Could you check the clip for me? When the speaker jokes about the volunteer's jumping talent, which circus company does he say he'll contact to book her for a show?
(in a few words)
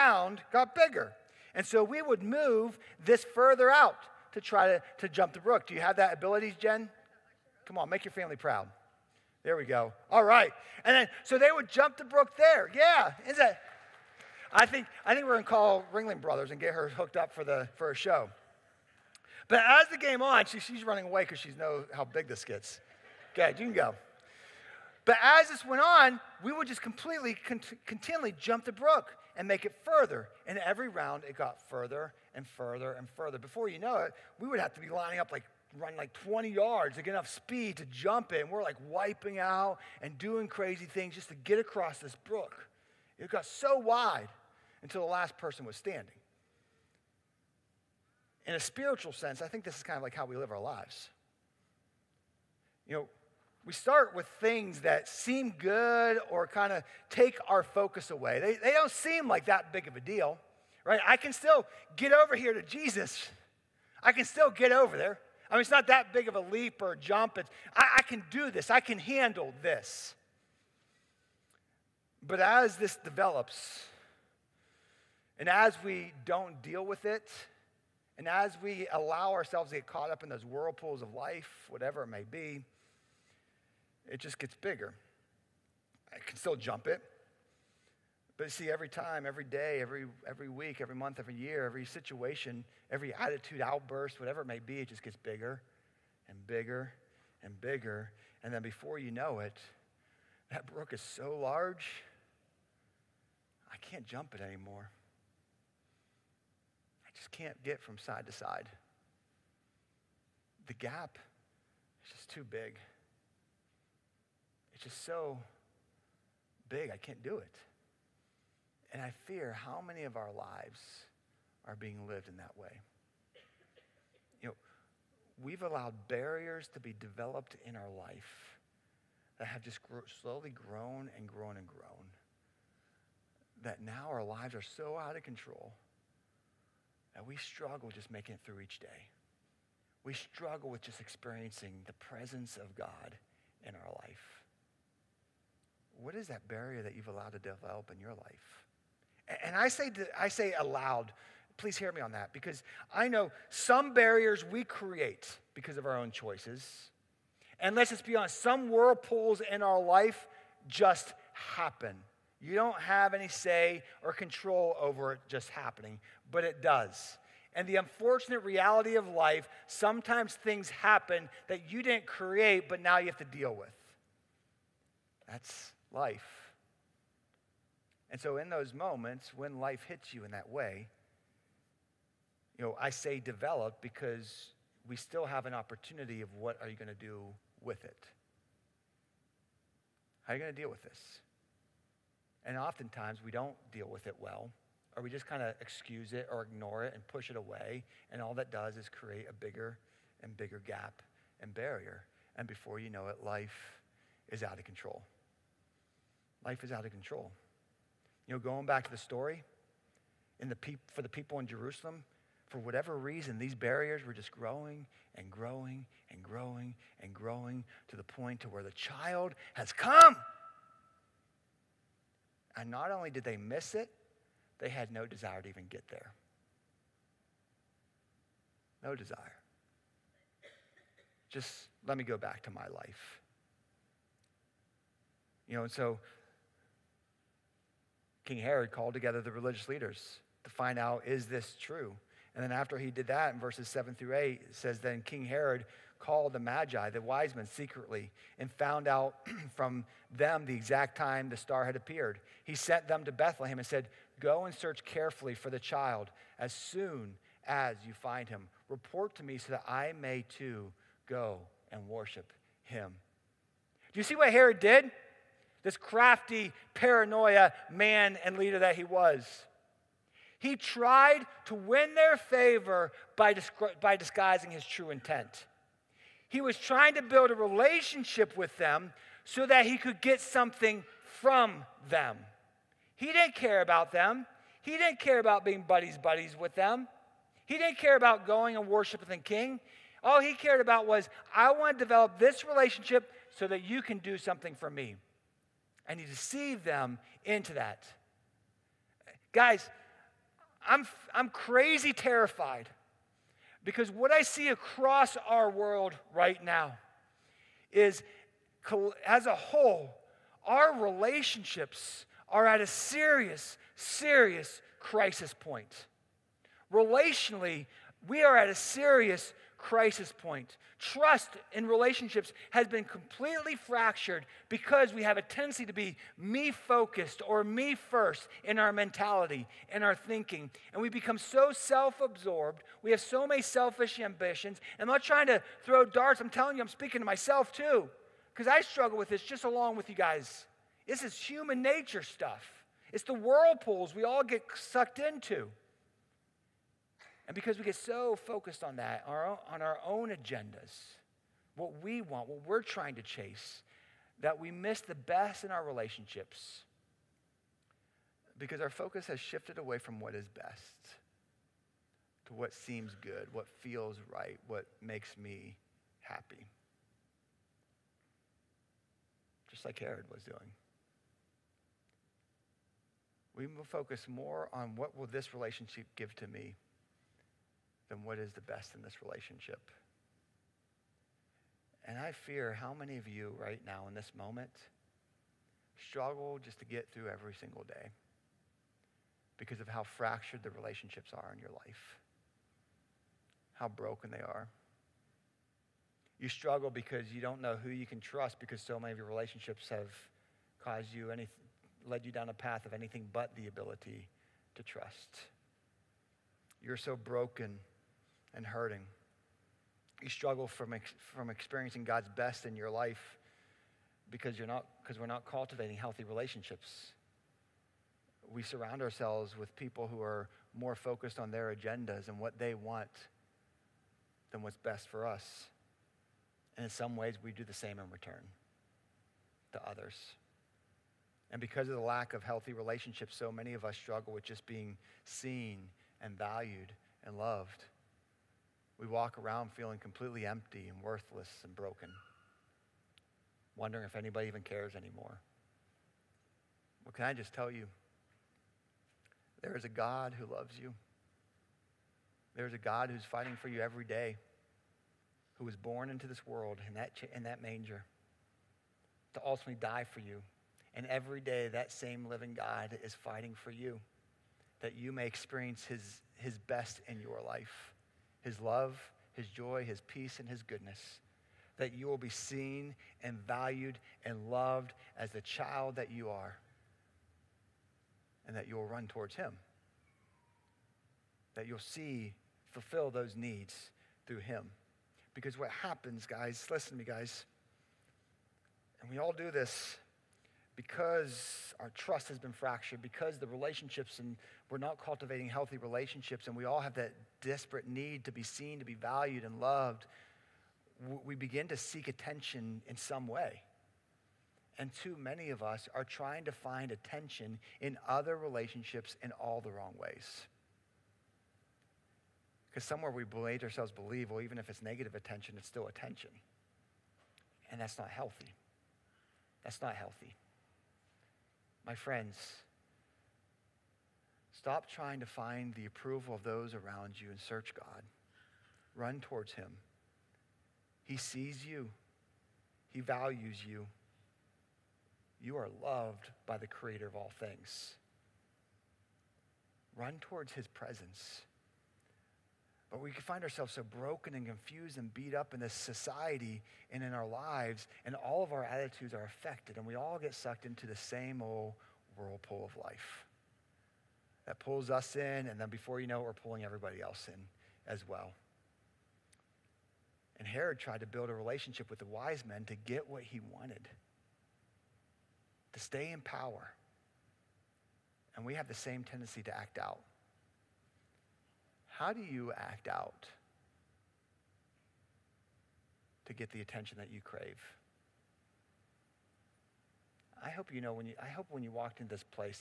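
Ringling Brothers.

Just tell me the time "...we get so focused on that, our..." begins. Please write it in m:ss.
5:47.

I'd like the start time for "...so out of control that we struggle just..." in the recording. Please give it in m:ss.
2:14.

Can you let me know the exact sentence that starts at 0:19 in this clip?
But as the game on, she, she's running away because she knows how big this gets.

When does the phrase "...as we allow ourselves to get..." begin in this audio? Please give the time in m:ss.
1:18.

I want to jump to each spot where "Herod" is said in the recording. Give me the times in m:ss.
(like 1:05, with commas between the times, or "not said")
3:58, 4:05, 4:24, 6:09, 9:20.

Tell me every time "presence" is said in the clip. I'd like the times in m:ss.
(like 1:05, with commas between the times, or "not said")
2:21, 9:00.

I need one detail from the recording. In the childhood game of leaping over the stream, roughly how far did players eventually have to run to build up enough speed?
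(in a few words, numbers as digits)
20 yards.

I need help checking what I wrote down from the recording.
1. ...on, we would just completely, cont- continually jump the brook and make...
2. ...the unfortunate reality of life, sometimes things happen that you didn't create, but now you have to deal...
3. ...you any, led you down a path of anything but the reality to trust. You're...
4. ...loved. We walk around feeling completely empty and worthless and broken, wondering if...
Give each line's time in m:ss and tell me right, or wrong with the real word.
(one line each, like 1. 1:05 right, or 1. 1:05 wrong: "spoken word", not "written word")
1. 0:25 right
2. 2:47 right
3. 6:40 wrong: "ability", not "reality"
4. 7:17 right.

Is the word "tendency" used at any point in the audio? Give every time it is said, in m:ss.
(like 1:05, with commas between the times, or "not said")
5:25, 9:28.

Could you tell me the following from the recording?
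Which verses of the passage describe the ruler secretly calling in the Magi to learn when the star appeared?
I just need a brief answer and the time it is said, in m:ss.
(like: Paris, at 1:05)
7 through 8, at 4:03.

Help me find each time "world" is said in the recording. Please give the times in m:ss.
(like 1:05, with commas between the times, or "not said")
5:05, 7:36.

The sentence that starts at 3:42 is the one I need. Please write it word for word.
And not only did they miss it, they had no desire to even get there.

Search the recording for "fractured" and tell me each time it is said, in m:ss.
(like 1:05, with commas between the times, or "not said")
5:23, 6:29, 8:12.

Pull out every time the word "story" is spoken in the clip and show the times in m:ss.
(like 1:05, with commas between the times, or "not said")
3:28.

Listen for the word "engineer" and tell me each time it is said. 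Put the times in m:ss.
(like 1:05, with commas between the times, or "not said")
not said.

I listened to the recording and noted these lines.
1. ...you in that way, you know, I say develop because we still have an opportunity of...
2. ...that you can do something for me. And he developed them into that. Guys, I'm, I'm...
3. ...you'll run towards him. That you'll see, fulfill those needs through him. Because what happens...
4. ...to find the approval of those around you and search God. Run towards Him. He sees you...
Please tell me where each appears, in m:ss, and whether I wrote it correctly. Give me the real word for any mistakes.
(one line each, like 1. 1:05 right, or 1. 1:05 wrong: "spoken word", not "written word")
1. 3:00 right
2. 4:53 wrong: "deceived", not "developed"
3. 7:58 right
4. 8:44 right.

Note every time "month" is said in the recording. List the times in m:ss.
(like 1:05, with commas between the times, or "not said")
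1:30.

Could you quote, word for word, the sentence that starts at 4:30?
He tried to win their favor by, by disguising his true intent.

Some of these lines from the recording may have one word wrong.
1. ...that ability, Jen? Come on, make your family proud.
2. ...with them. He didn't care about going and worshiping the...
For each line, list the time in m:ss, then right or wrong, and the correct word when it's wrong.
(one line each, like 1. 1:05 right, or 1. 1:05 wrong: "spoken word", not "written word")
1. 0:05 right
2. 4:46 right.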